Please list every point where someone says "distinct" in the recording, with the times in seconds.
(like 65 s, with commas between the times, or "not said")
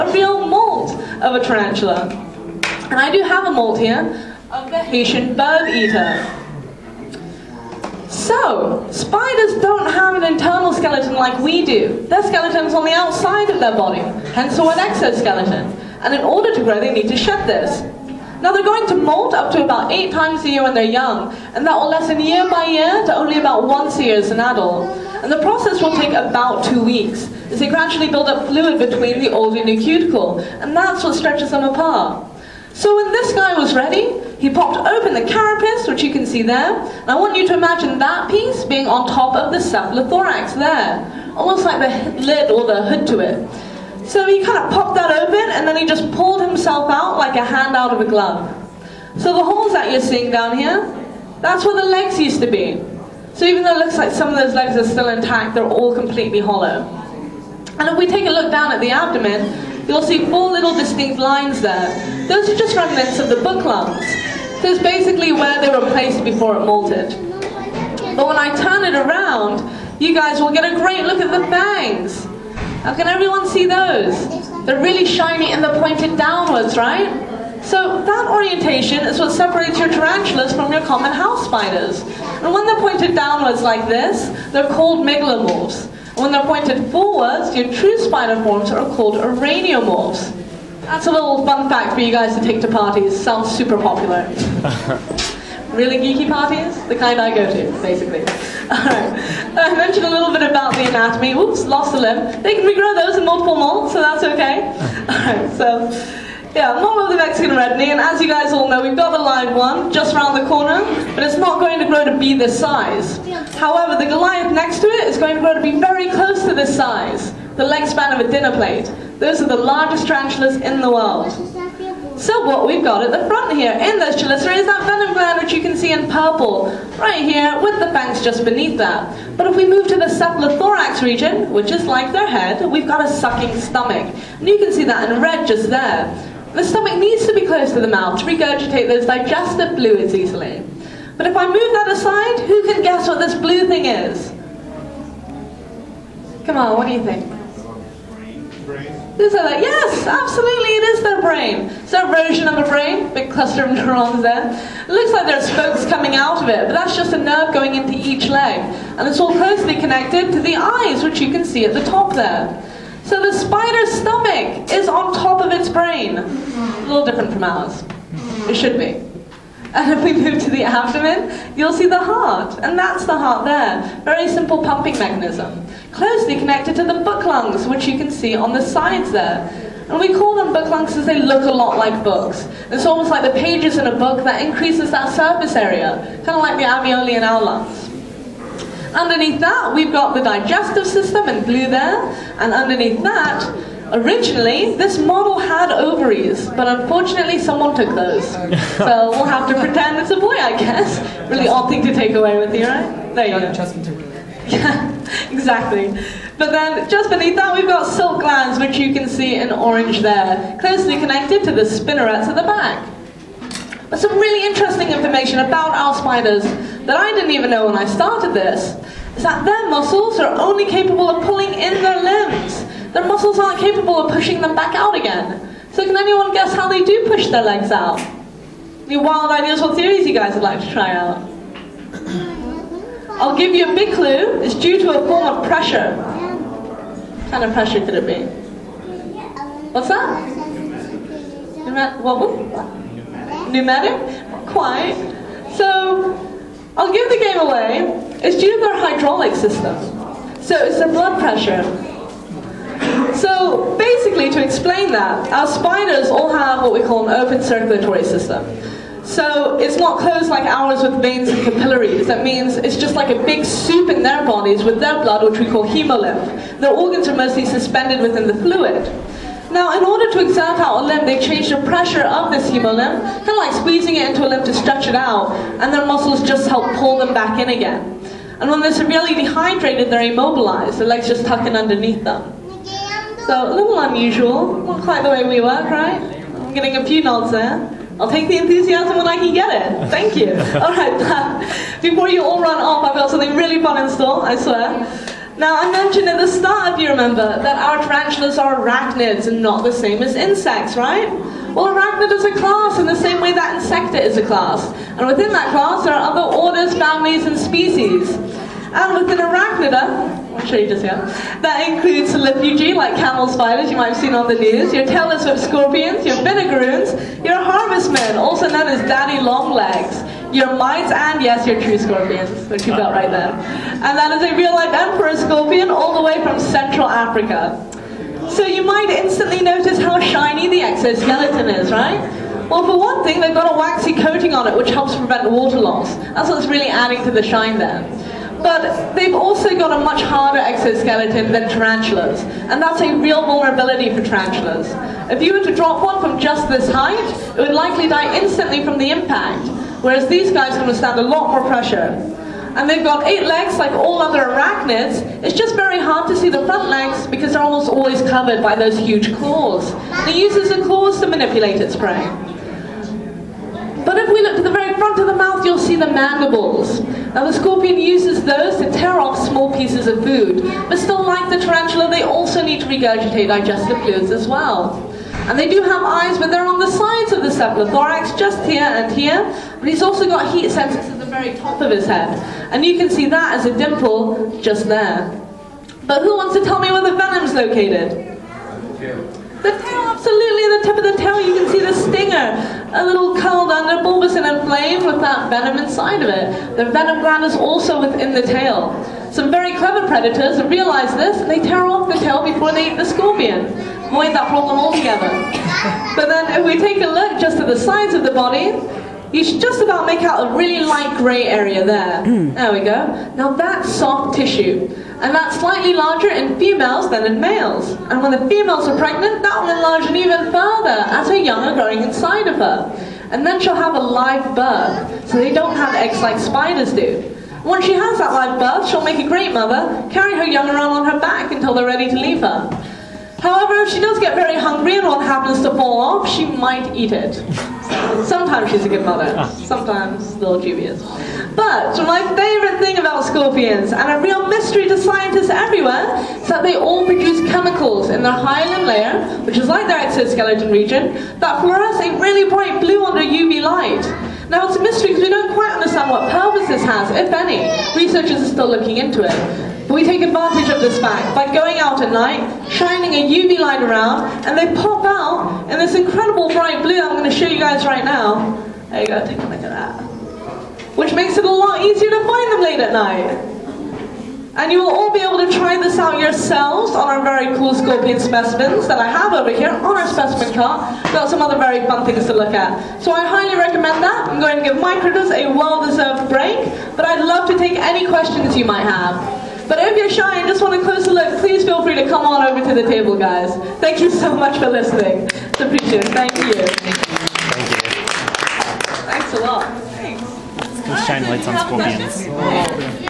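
60 s.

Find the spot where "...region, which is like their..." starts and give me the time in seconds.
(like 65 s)
131 s.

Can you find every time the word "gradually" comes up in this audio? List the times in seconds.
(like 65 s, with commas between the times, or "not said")
27 s.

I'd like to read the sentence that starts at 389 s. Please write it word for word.
The tail, absolutely, the tip of the tail, you can see the stinger.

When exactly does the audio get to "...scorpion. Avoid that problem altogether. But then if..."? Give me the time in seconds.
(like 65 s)
402 s.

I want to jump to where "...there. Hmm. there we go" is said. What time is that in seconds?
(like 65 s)
411 s.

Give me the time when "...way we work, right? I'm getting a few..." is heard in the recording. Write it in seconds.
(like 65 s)
285 s.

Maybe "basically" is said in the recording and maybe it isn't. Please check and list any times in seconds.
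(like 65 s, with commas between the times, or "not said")
64 s, 97 s.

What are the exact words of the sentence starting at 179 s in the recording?
And we call them book lungs because they look a lot like books.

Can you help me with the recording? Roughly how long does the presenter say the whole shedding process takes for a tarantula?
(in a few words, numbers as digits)
About two weeks.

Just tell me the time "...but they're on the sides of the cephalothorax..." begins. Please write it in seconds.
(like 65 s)
376 s.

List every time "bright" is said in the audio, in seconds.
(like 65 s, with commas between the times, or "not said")
452 s, 466 s.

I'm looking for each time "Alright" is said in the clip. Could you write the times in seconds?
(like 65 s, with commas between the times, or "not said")
105 s.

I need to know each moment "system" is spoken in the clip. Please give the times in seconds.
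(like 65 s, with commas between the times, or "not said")
190 s, 249 s, 258 s.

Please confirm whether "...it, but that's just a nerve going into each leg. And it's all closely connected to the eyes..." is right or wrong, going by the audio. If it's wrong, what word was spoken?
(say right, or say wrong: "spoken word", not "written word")
right.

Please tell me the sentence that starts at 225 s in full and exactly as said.
So can anyone guess how they do push their legs out?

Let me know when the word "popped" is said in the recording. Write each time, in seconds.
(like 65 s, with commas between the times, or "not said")
34 s, 44 s.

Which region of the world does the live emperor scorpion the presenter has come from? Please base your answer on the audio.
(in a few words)
Central Africa.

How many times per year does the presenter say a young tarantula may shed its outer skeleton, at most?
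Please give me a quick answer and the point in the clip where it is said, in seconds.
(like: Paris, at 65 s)
8, at 19 s.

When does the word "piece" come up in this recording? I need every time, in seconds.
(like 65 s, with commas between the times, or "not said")
38 s, 369 s.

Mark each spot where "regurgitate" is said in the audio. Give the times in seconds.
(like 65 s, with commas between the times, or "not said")
138 s, 372 s.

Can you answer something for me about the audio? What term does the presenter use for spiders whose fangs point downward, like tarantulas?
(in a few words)
Megalomorphs.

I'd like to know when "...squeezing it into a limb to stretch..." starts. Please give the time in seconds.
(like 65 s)
273 s.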